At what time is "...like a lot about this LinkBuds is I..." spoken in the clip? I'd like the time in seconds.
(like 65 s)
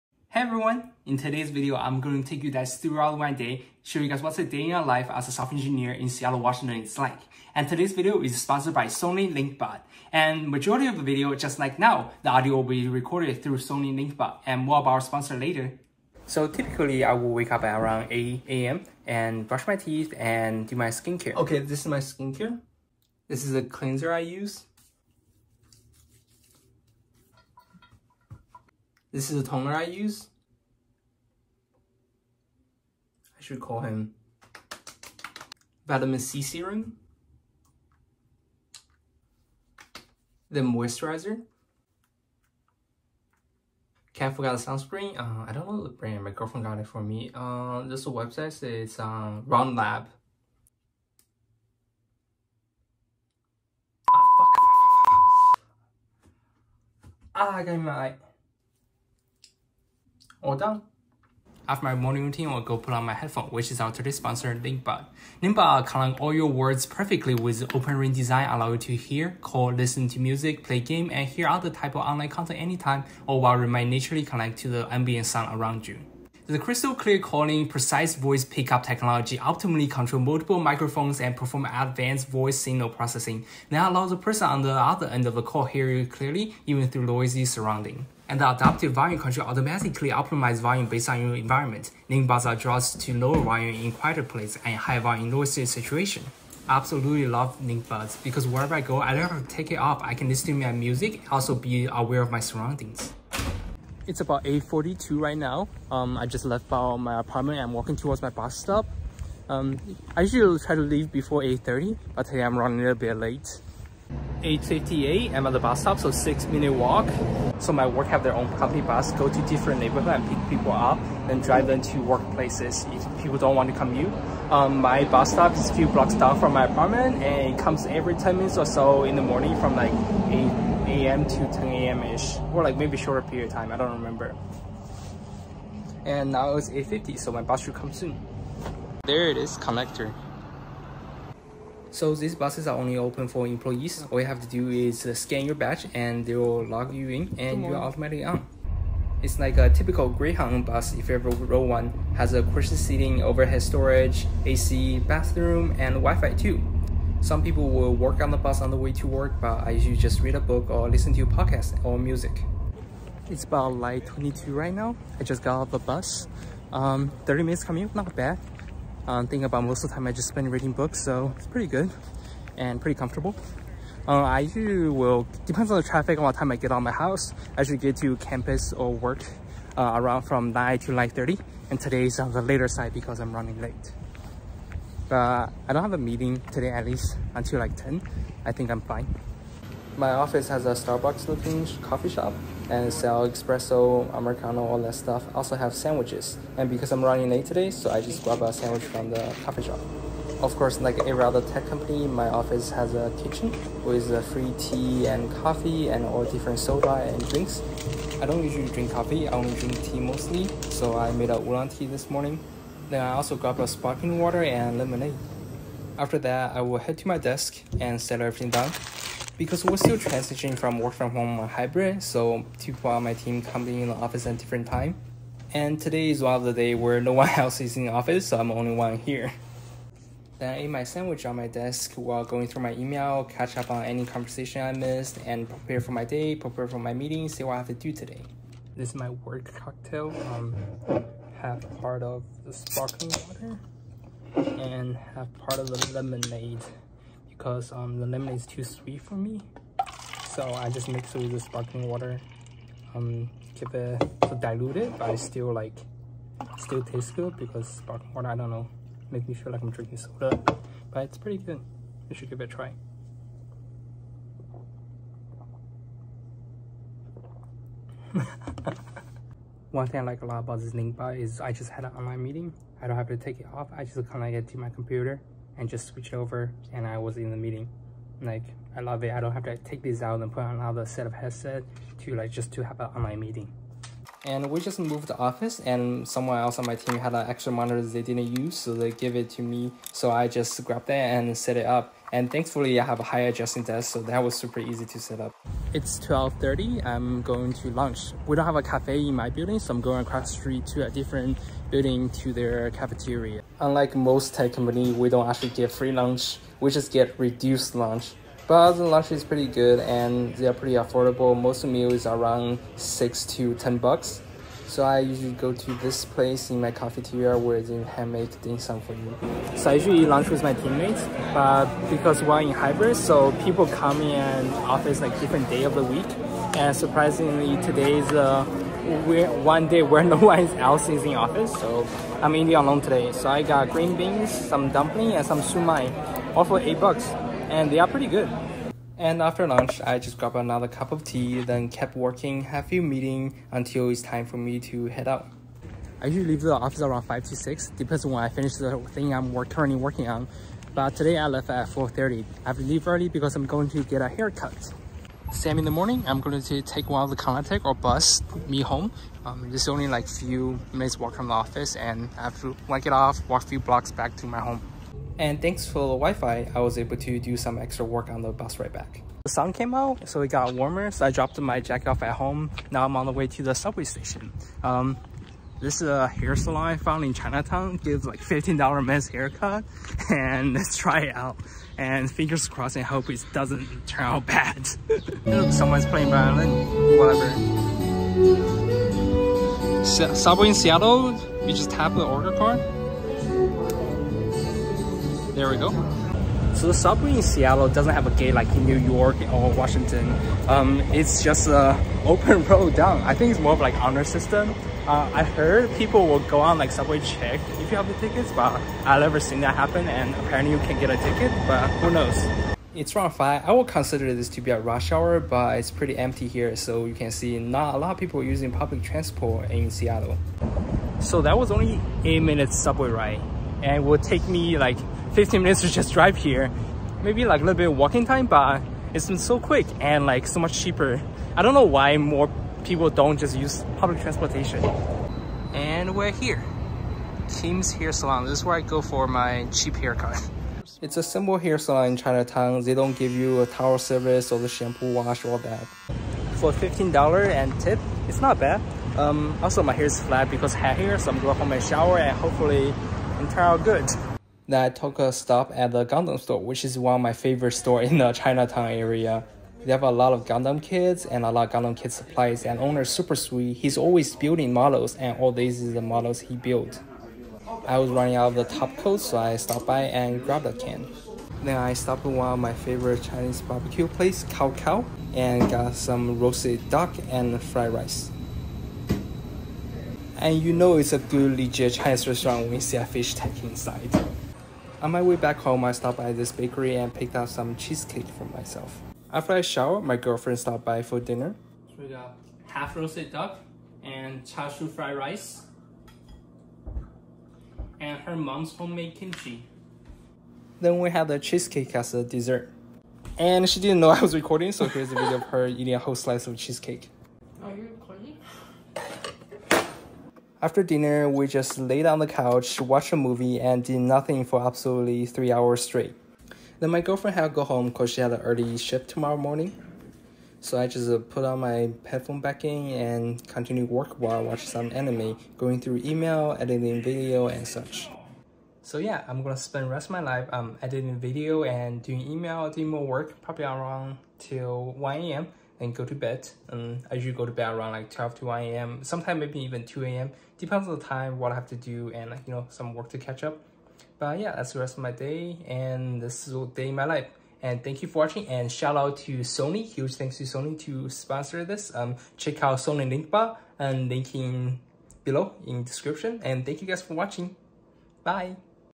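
270 s.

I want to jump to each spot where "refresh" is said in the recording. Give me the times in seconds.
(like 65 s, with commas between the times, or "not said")
not said.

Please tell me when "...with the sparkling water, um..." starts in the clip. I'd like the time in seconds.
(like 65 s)
251 s.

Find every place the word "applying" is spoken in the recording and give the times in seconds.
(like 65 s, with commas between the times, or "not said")
not said.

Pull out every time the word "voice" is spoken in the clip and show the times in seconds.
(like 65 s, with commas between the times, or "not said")
78 s, 82 s.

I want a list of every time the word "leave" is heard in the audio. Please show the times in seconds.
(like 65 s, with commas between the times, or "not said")
110 s, 346 s, 352 s.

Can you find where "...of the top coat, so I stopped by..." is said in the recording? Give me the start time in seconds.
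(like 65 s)
468 s.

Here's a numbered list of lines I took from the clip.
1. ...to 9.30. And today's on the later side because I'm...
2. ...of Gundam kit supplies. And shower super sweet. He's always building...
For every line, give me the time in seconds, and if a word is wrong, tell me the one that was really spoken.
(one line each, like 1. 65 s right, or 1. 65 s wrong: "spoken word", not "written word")
1. 180 s right
2. 461 s wrong: "owner", not "shower".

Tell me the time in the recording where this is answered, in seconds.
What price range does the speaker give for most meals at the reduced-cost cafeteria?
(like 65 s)
312 s.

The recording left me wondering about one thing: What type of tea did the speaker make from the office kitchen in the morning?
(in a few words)
Oolong.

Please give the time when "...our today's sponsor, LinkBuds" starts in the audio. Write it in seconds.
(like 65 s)
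63 s.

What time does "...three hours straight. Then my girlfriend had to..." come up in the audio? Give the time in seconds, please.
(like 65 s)
515 s.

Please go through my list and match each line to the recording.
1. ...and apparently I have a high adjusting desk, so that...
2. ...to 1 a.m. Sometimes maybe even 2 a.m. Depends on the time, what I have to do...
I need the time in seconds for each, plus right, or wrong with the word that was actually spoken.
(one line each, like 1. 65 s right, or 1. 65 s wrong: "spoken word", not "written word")
1. 292 s wrong: "thankfully", not "apparently"
2. 538 s right.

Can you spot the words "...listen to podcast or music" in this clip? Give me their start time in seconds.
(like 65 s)
160 s.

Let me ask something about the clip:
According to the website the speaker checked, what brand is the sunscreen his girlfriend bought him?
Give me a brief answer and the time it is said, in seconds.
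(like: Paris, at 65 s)
Round Lab, at 49 s.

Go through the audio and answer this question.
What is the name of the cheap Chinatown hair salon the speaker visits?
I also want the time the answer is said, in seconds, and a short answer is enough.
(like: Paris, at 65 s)
Teams Hair Salon, at 437 s.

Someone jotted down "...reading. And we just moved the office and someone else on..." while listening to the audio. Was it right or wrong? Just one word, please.
wrong.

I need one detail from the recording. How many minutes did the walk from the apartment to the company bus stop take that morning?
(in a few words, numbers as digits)
6.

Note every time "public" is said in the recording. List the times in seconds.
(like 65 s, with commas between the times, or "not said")
418 s, 433 s.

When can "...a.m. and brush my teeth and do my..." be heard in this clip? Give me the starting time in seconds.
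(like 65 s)
18 s.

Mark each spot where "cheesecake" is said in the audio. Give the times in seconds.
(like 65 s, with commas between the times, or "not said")
487 s, 501 s, 506 s.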